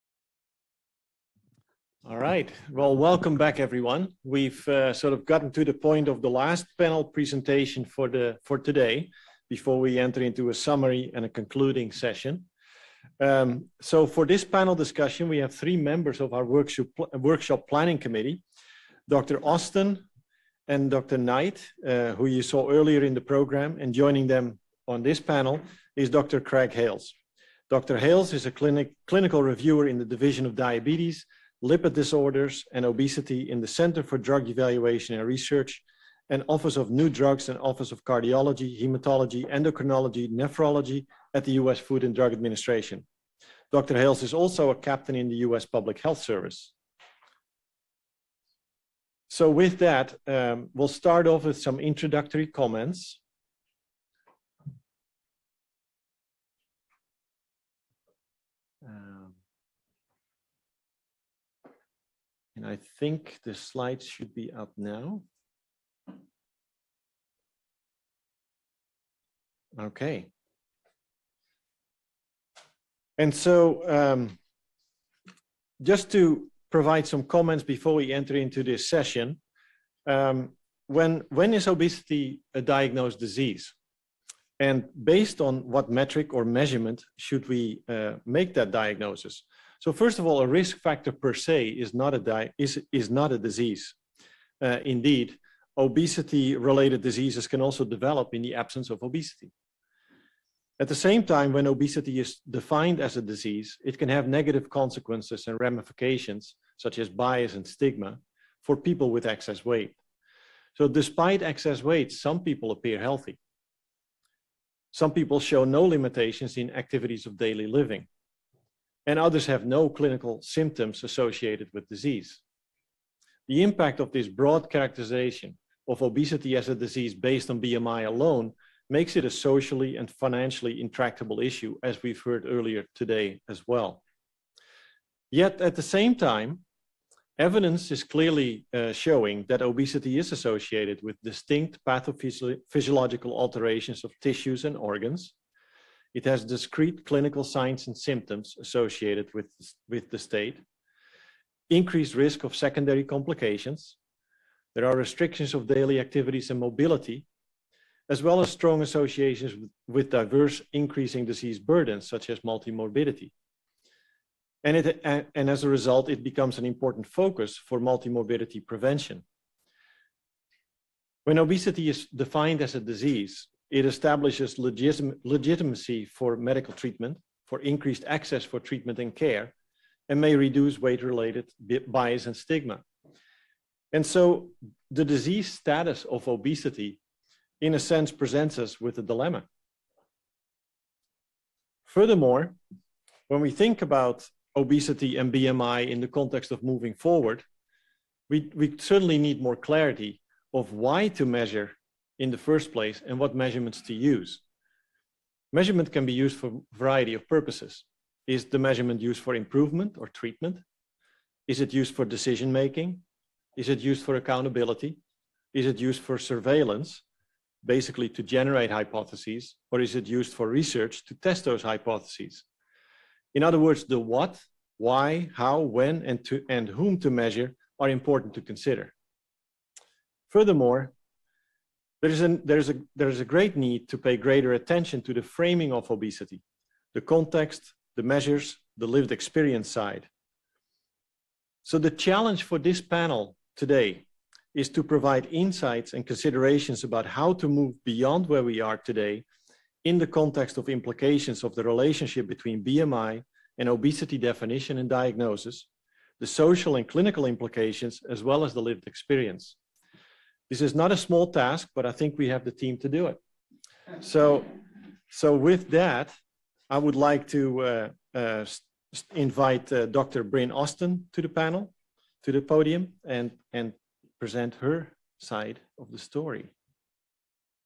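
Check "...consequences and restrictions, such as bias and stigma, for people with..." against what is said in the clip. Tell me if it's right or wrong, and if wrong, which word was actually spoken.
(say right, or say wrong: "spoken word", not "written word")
wrong: "ramifications", not "restrictions".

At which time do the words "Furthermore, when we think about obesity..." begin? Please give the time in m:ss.
3:11.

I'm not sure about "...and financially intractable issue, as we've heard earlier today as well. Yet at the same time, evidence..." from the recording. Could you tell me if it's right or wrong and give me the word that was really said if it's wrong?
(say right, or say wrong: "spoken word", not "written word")
right.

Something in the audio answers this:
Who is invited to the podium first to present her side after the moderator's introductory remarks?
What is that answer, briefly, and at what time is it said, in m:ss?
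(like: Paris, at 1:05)
Dr. Bryn Austin, at 4:29.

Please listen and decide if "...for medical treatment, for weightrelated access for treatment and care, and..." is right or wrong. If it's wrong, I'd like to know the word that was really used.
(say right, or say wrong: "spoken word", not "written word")
wrong: "increased", not "weightrelated".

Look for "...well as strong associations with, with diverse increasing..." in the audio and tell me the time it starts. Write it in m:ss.
2:38.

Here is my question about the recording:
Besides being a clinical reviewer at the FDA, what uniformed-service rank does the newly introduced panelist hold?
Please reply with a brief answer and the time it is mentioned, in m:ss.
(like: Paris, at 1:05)
Captain, at 0:44.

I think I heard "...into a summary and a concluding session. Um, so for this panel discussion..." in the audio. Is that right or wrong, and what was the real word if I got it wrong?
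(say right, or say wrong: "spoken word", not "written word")
right.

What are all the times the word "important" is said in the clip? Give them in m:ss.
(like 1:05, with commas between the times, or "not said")
2:46, 3:47.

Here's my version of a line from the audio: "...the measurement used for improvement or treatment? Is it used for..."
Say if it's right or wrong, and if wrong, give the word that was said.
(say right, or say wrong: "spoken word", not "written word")
right.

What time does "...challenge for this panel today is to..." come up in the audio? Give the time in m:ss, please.
4:01.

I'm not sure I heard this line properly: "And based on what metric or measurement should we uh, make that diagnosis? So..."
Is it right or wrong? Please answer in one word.
right.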